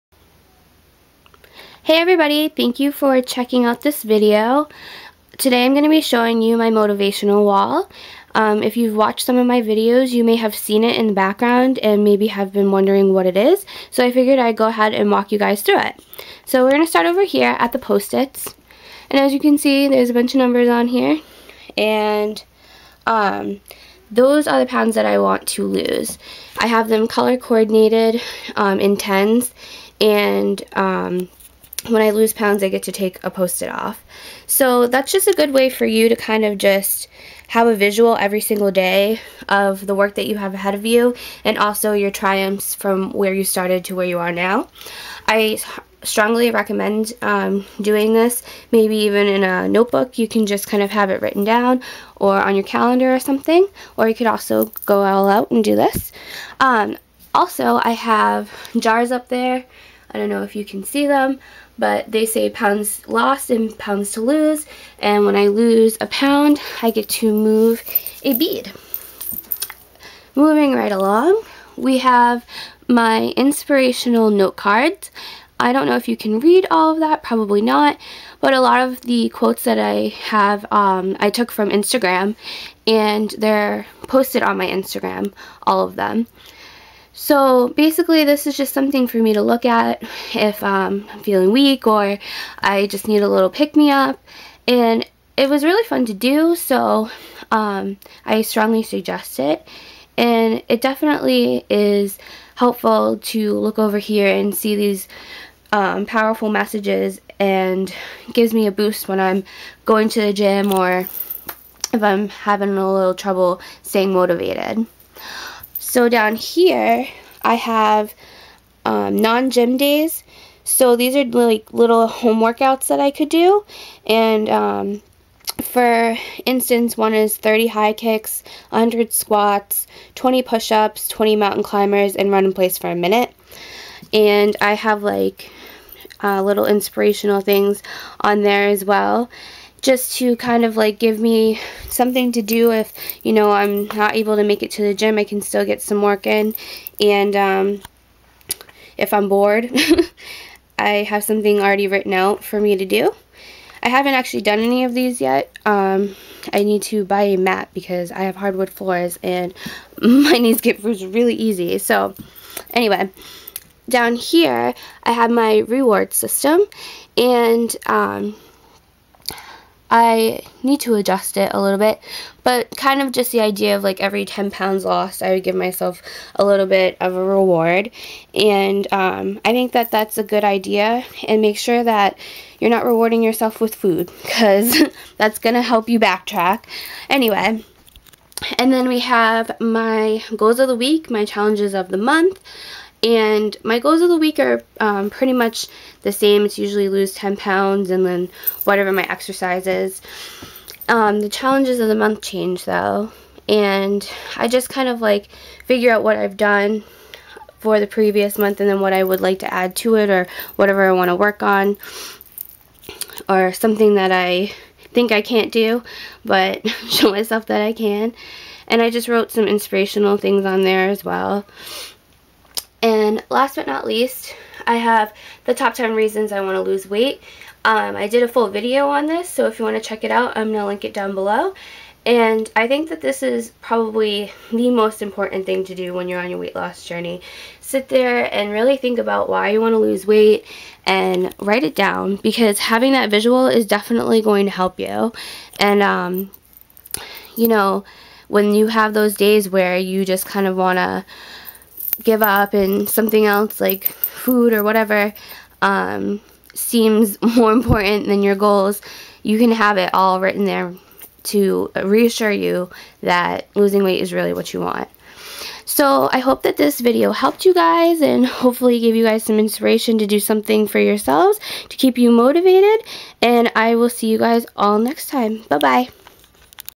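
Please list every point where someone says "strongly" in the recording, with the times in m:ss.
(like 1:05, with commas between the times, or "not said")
0:46, 1:38.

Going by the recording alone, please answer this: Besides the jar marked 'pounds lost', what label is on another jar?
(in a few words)
pounds to lose.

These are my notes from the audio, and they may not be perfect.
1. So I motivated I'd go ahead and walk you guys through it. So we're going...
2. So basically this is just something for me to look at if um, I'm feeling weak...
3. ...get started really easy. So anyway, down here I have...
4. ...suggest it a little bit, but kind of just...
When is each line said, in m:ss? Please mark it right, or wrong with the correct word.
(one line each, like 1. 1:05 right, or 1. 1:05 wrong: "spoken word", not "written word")
1. 0:13 wrong: "figured", not "motivated"
2. 1:27 right
3. 2:40 wrong: "bruised", not "started"
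4. 2:50 wrong: "adjust", not "suggest".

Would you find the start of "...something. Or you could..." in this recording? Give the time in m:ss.
0:53.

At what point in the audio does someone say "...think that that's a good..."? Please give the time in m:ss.
2:59.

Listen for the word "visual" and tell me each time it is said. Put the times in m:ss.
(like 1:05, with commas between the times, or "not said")
0:37, 4:03.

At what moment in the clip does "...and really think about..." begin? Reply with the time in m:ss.
3:58.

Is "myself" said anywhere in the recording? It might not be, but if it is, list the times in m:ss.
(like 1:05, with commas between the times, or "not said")
2:55, 3:37.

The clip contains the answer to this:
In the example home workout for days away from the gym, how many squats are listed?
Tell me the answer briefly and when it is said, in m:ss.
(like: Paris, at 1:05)
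100, at 2:08.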